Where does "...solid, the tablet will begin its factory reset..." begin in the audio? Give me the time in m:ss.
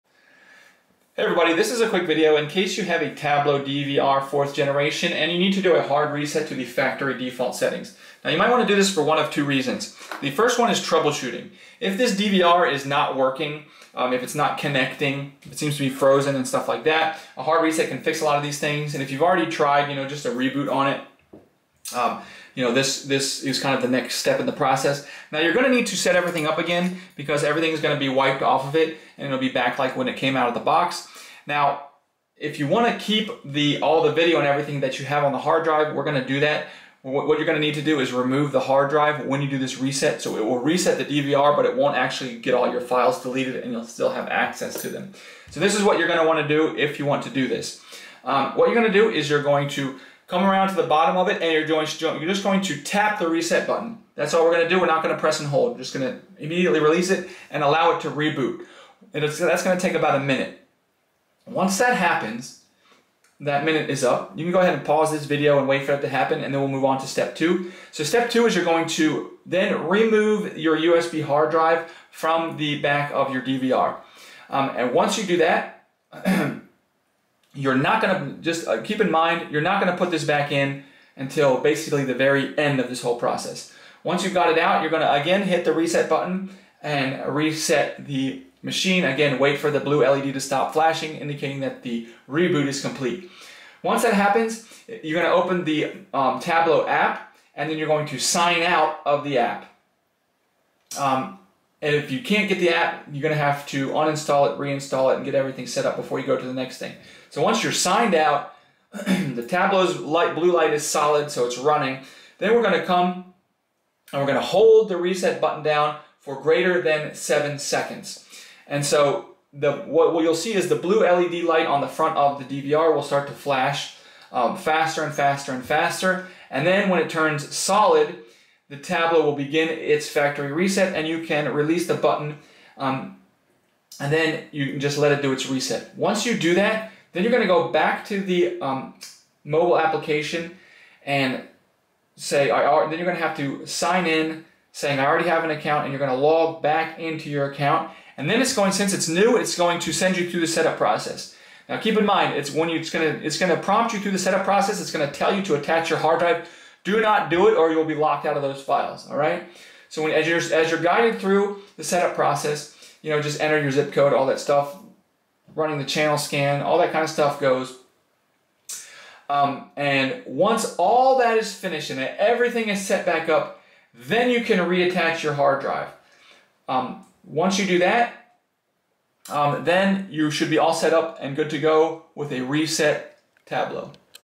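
2:07.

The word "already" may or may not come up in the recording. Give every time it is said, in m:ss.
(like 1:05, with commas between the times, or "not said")
0:19, 2:25.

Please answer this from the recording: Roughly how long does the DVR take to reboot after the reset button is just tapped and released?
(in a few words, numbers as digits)
about a minute.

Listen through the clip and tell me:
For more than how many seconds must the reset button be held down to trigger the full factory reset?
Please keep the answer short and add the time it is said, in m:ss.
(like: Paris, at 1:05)
7, at 1:57.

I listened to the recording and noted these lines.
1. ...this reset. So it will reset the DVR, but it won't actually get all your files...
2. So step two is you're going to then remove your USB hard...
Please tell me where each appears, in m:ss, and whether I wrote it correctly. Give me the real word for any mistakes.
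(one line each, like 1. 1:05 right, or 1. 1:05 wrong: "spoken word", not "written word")
1. 0:39 right
2. 1:07 right.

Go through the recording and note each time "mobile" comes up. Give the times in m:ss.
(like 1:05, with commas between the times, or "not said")
2:19.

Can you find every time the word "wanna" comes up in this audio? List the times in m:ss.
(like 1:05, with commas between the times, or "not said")
0:32, 0:46.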